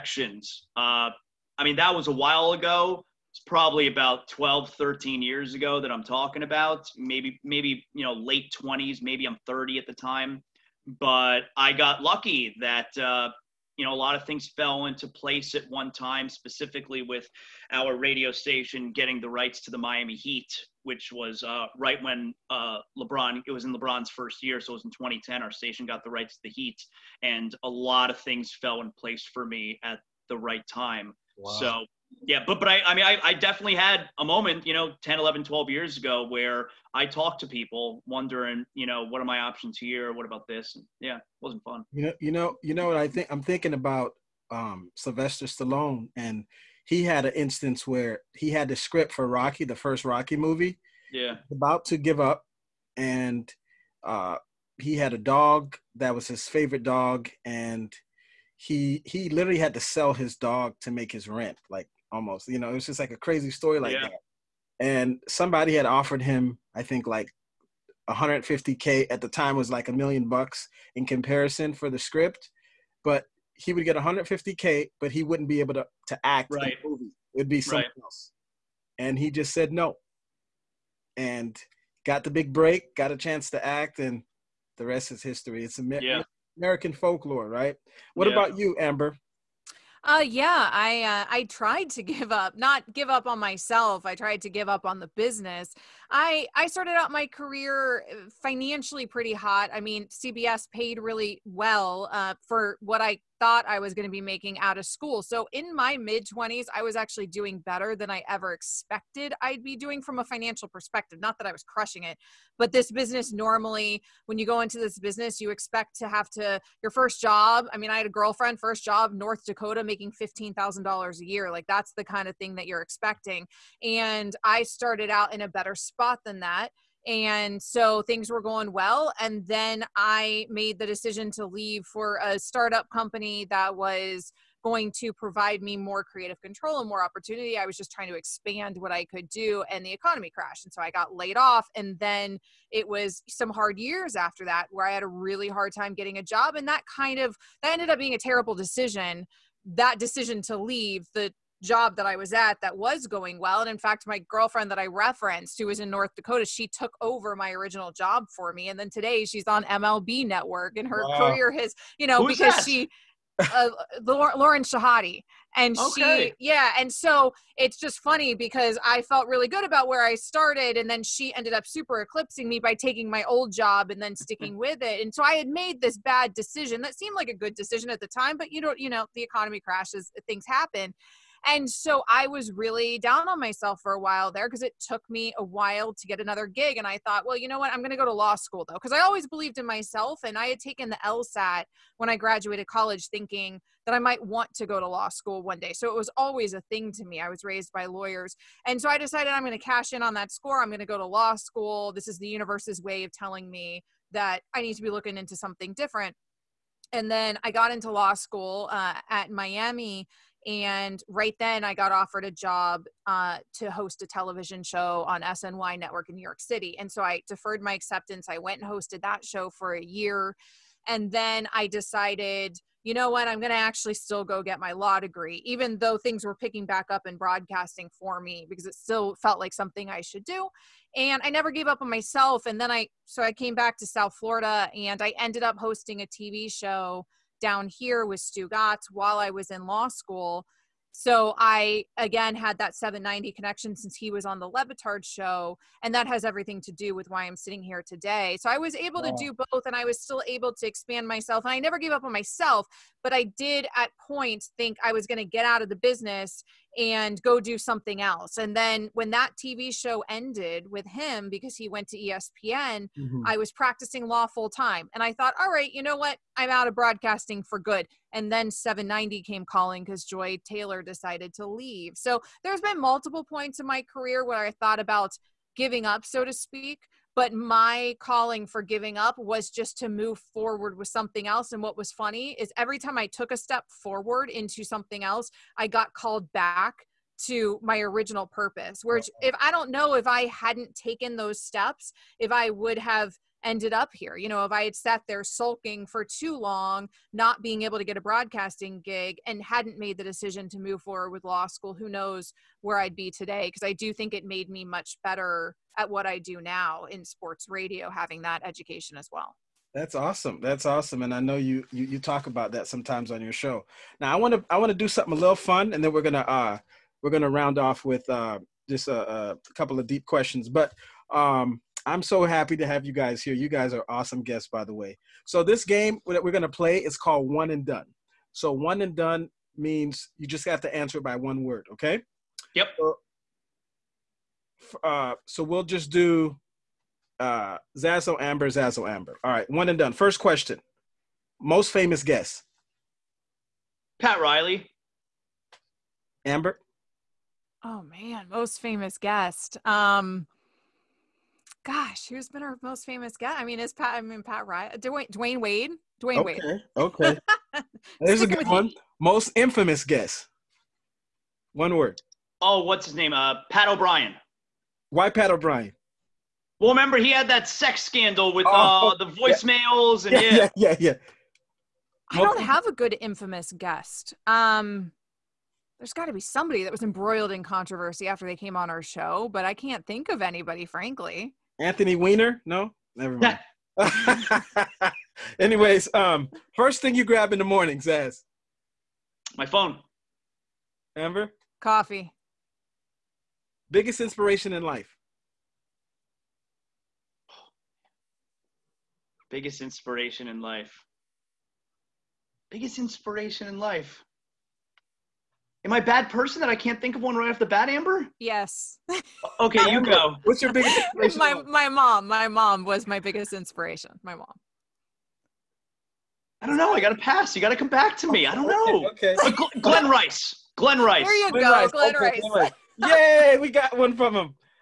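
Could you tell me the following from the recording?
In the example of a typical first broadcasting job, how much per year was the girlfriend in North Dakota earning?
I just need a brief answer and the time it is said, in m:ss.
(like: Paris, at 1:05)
$15,000, at 2:00.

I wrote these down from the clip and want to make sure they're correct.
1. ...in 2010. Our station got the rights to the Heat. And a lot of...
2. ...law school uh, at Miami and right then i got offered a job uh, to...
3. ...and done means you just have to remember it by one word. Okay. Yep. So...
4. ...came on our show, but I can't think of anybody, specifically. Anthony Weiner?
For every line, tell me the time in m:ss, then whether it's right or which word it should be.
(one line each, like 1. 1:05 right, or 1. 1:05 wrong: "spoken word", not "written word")
1. 0:24 right
2. 3:27 right
3. 5:28 wrong: "answer", not "remember"
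4. 6:18 wrong: "frankly", not "specifically".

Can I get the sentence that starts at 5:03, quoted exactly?
Because I do think it made me much better at what I do now in sports radio, having that education as well.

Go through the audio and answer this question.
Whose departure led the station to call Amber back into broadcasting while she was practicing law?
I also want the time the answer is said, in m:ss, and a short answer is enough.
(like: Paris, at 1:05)
Joy Taylor, at 4:30.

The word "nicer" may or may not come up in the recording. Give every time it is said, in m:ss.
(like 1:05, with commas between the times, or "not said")
not said.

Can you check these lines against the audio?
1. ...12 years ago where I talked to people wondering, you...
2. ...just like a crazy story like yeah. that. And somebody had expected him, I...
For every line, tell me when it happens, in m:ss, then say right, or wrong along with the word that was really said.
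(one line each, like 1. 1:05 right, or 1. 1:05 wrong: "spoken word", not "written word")
1. 0:35 right
2. 1:02 wrong: "offered", not "expected".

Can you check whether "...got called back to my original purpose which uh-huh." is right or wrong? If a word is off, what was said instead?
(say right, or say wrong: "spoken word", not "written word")
right.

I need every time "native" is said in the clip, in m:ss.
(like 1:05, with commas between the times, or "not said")
not said.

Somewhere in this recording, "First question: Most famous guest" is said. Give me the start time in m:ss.
5:39.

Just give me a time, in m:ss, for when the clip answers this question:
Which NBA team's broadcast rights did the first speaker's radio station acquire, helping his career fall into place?
0:19.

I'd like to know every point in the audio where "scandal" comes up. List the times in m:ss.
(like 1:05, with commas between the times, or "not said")
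6:07.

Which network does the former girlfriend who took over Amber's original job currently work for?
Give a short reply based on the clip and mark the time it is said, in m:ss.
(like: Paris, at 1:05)
MLB Network, at 2:39.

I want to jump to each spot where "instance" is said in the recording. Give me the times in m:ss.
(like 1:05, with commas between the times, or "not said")
0:47.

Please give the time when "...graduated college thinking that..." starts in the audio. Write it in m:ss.
3:12.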